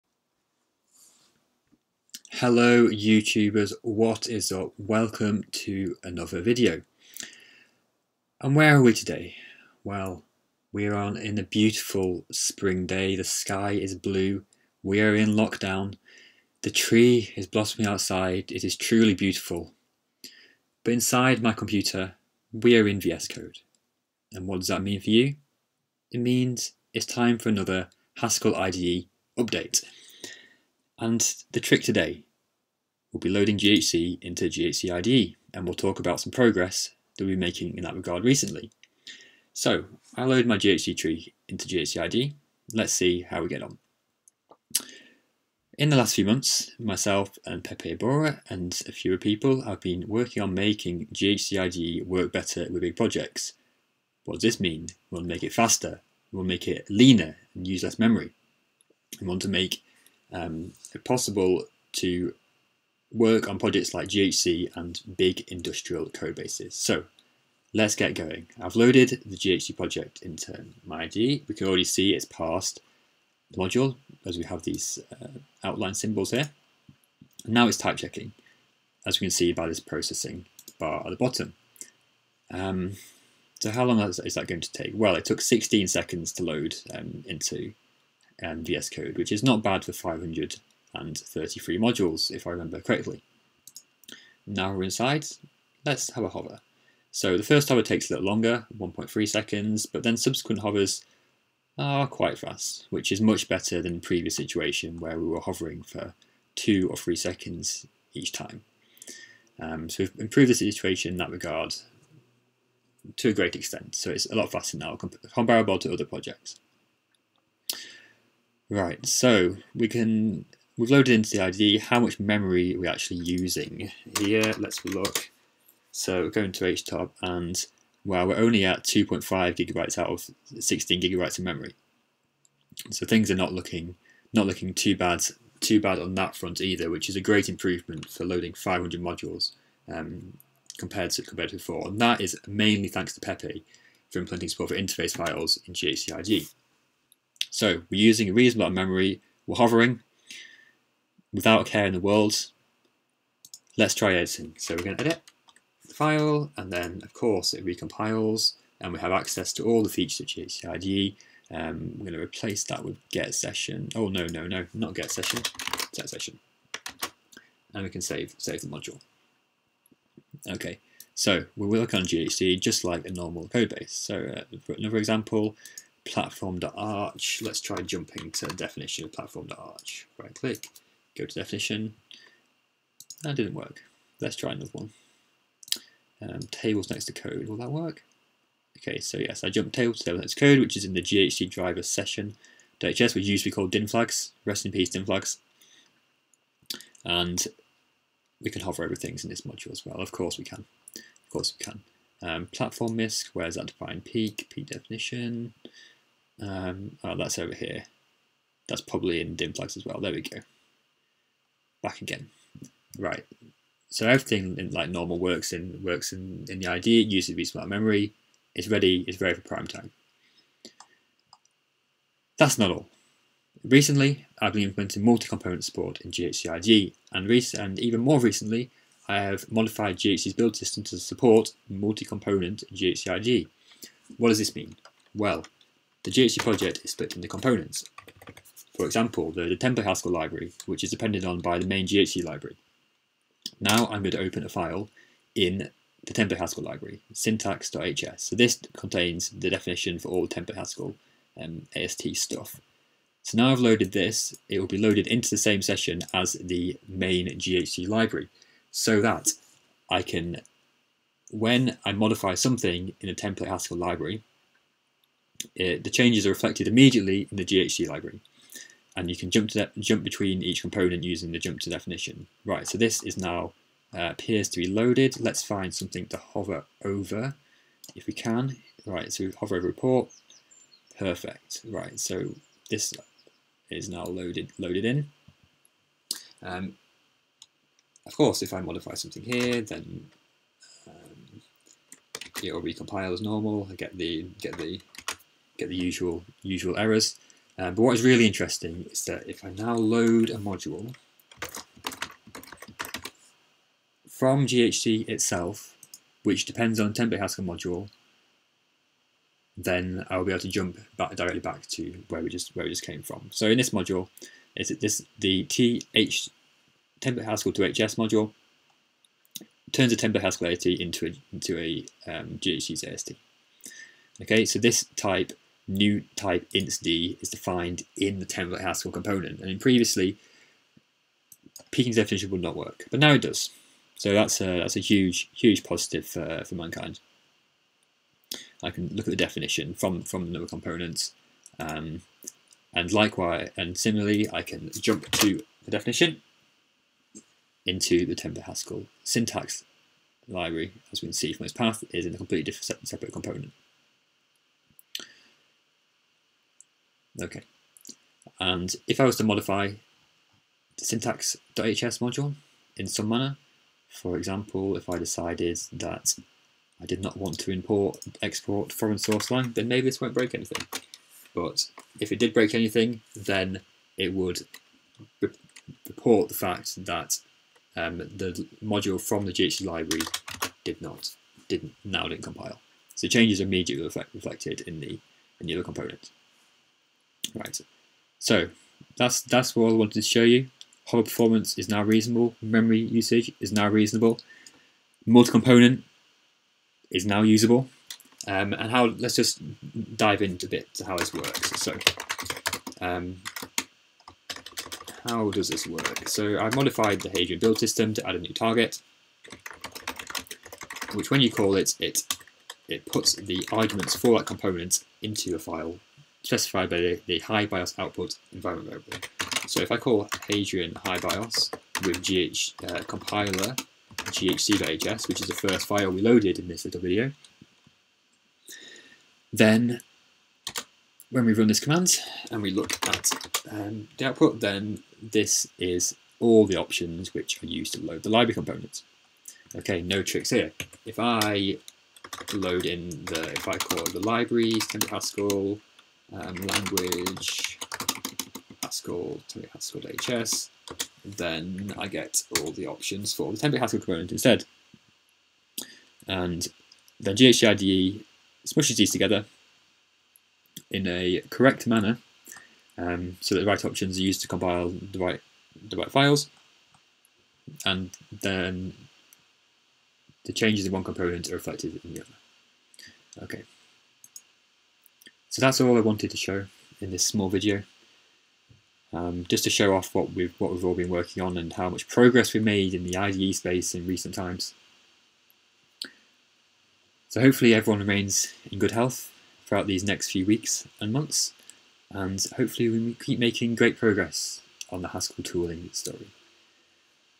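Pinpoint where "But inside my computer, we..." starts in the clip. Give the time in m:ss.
0:20.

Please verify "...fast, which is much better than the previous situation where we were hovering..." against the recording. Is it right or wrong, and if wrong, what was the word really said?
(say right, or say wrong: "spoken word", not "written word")
right.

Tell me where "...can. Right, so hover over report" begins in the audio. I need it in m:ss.
4:38.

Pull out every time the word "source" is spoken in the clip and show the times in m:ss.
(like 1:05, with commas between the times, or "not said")
6:08.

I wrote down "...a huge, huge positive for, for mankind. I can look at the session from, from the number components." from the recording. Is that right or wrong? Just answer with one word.
wrong.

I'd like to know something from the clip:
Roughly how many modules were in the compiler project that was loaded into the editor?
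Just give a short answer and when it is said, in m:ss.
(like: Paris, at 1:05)
533, at 1:29.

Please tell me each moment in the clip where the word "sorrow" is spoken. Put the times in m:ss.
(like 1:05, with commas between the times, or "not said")
not said.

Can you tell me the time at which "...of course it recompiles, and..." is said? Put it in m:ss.
2:37.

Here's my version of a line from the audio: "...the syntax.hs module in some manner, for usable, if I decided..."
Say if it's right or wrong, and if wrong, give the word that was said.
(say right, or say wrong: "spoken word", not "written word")
wrong: "example", not "usable".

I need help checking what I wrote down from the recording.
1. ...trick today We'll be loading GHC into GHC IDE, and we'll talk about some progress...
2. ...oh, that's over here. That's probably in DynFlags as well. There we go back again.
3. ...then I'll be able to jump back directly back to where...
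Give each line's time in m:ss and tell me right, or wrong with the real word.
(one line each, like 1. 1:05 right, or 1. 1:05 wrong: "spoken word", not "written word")
1. 0:31 right
2. 3:27 right
3. 5:09 right.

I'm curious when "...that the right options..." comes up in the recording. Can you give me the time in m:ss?
7:43.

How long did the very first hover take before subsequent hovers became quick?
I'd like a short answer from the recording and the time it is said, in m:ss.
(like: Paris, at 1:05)
1.3 seconds, at 1:38.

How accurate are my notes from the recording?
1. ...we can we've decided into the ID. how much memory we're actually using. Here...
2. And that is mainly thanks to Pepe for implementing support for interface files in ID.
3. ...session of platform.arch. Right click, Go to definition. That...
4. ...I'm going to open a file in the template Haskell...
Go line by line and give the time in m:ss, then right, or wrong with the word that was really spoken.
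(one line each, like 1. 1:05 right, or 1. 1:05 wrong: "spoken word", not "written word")
1. 1:59 wrong: "loaded", not "decided"
2. 2:21 right
3. 2:58 wrong: "definition", not "session"
4. 4:03 right.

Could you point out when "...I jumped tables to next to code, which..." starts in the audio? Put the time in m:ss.
3:09.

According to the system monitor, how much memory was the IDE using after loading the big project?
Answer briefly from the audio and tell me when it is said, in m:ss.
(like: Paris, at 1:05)
2.5 gigabytes, at 2:08.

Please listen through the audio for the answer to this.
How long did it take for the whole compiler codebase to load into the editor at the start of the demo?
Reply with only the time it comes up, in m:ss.
1:25.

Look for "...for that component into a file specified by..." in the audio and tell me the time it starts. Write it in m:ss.
6:53.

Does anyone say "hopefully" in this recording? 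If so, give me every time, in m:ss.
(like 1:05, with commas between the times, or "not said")
8:07, 8:12.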